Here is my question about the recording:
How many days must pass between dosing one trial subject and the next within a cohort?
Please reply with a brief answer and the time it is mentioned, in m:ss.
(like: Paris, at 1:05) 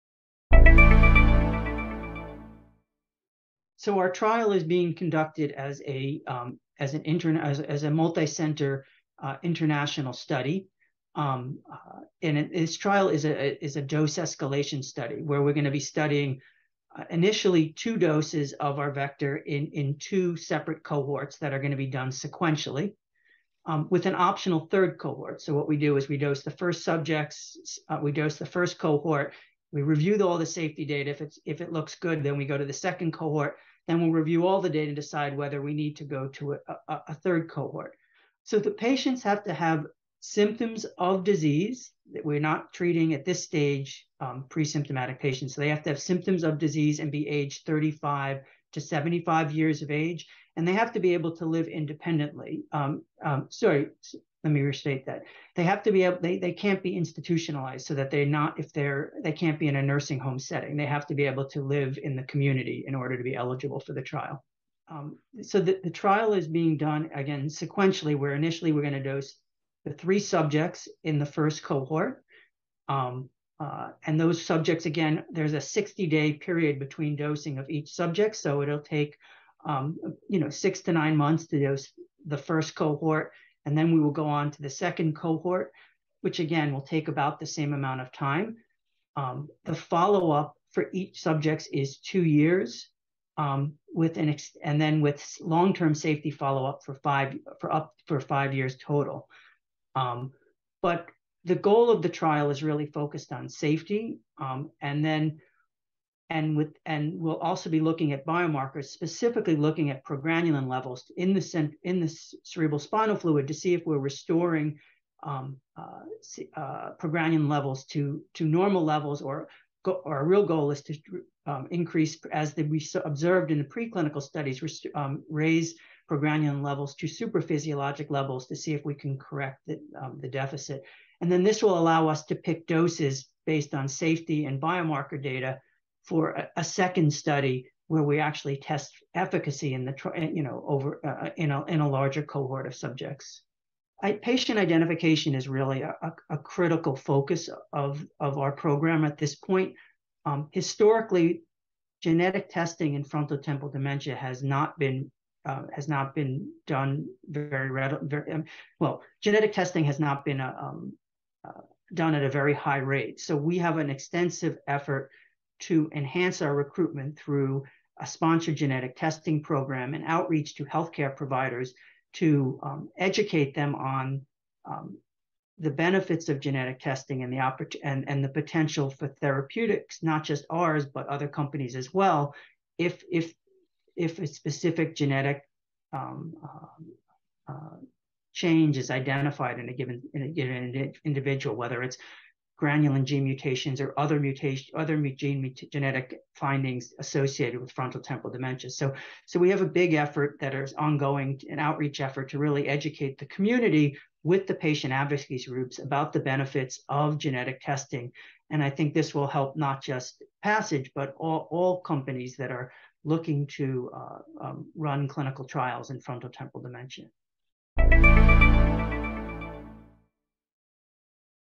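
60, at 1:15.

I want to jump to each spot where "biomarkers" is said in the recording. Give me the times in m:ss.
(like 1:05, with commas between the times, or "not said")
1:48, 2:14.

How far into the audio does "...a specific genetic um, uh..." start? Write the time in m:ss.
3:04.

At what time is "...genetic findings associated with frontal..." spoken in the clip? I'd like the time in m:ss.
3:15.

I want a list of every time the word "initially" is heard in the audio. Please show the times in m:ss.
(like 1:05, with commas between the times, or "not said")
0:17, 1:08.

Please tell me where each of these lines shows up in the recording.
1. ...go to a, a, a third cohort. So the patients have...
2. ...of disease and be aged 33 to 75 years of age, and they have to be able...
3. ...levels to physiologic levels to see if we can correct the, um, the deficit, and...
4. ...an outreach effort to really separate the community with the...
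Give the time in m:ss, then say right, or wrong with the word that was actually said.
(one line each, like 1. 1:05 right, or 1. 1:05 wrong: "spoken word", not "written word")
1. 0:36 right
2. 0:46 wrong: "35", not "33"
3. 2:06 right
4. 3:21 wrong: "educate", not "separate".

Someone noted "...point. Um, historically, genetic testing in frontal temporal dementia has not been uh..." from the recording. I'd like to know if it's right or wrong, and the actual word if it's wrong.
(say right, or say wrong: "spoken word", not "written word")
right.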